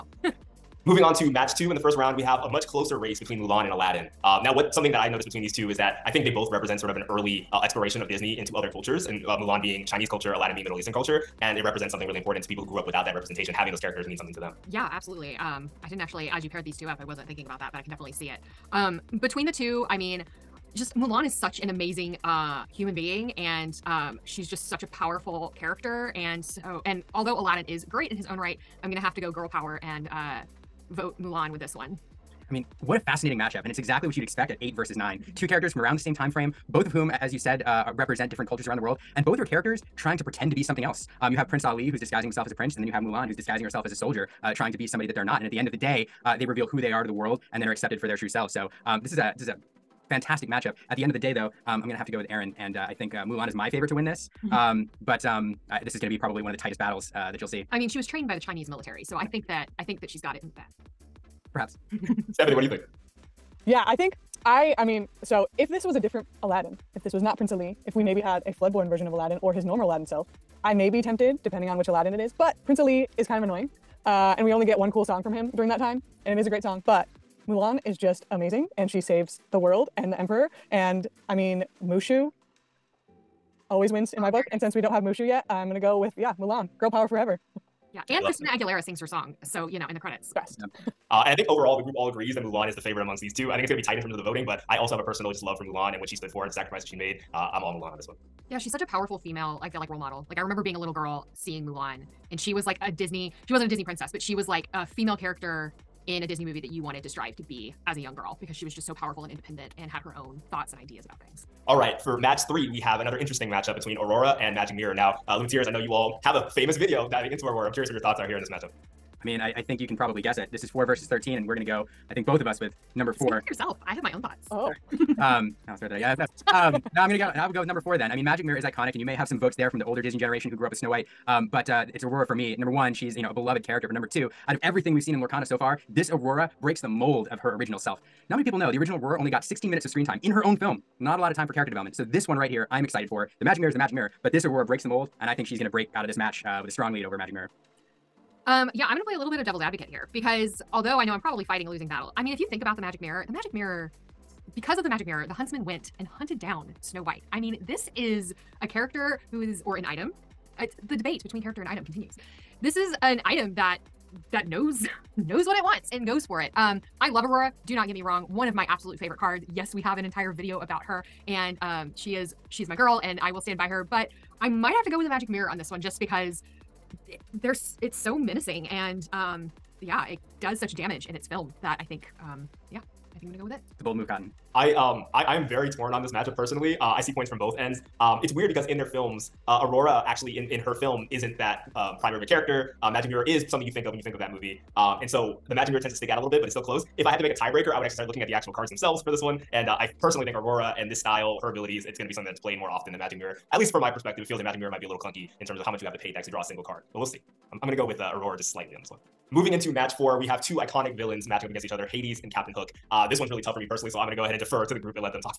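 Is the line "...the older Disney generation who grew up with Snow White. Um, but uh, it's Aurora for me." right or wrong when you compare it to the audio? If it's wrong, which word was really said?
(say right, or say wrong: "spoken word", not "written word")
right.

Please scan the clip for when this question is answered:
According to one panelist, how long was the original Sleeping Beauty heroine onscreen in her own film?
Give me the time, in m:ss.
2:19.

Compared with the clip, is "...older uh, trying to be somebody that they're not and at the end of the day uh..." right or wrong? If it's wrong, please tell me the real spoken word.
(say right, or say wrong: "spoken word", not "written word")
wrong: "soldier", not "older".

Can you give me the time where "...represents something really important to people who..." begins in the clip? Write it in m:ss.
0:11.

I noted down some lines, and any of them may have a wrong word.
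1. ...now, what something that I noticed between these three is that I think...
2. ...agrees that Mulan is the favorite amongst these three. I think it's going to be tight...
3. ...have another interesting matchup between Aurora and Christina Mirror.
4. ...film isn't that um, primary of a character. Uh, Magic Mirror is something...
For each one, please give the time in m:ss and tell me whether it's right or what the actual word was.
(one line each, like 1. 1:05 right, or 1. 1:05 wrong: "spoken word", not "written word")
1. 0:04 wrong: "two", not "three"
2. 1:32 wrong: "two", not "three"
3. 1:52 wrong: "Magic", not "Christina"
4. 3:10 right.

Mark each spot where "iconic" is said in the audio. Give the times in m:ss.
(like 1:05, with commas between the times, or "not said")
2:08, 3:30.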